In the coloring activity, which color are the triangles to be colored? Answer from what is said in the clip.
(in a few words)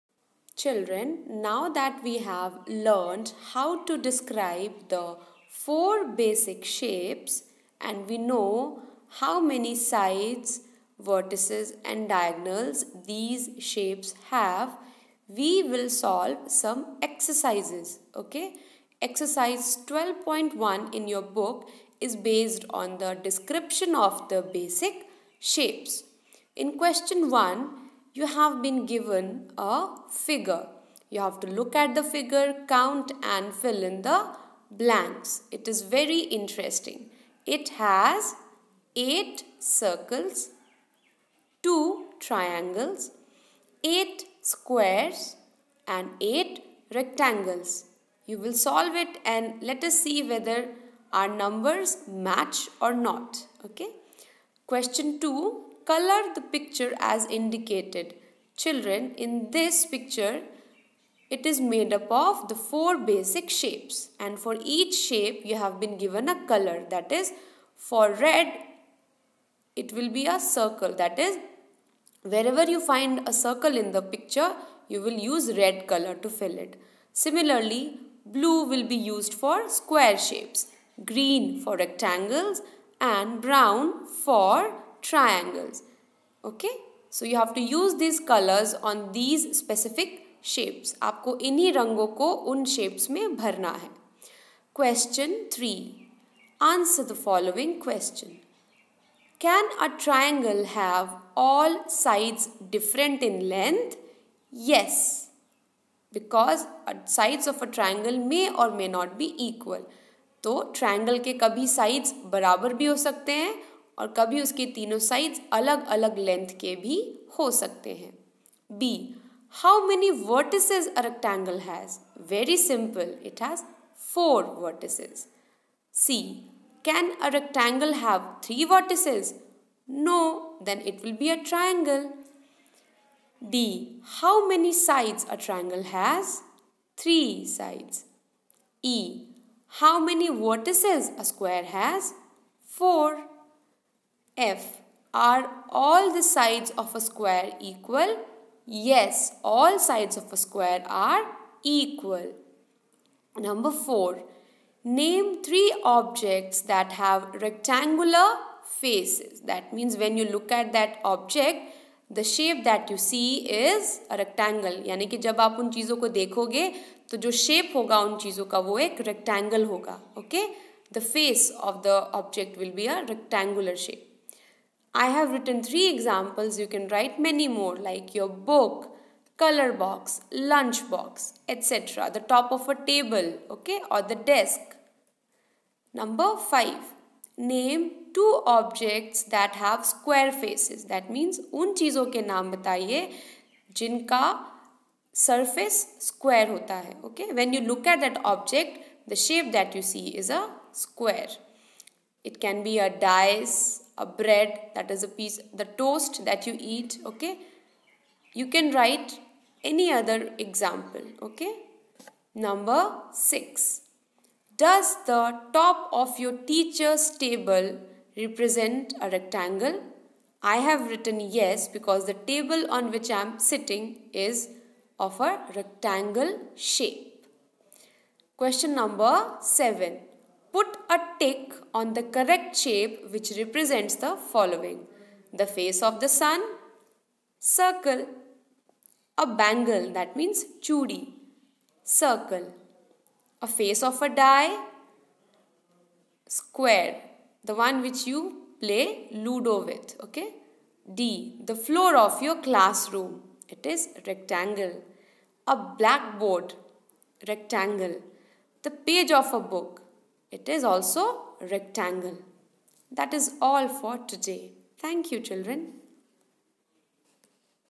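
Brown.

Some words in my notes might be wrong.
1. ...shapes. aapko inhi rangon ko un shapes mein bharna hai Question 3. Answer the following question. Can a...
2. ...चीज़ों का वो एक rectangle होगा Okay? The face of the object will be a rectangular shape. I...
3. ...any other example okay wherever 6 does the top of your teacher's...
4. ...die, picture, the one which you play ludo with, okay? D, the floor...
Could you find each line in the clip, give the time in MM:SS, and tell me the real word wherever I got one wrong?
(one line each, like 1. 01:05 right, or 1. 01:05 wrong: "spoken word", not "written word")
1. 01:30 right
2. 02:48 right
3. 03:29 wrong: "number", not "wherever"
4. 04:04 wrong: "square", not "picture".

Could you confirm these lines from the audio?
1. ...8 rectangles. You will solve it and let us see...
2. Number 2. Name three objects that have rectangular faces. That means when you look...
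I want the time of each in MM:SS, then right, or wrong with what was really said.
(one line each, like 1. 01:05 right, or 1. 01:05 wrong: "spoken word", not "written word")
1. 00:46 right
2. 02:33 wrong: "4", not "2".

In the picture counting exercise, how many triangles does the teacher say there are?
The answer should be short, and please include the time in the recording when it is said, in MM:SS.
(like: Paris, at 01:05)
2, at 00:41.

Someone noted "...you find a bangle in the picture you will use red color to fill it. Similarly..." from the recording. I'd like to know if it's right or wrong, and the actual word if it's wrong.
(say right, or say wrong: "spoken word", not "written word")
wrong: "circle", not "bangle".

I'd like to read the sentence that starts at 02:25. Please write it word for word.
Are all the sides of a square equal?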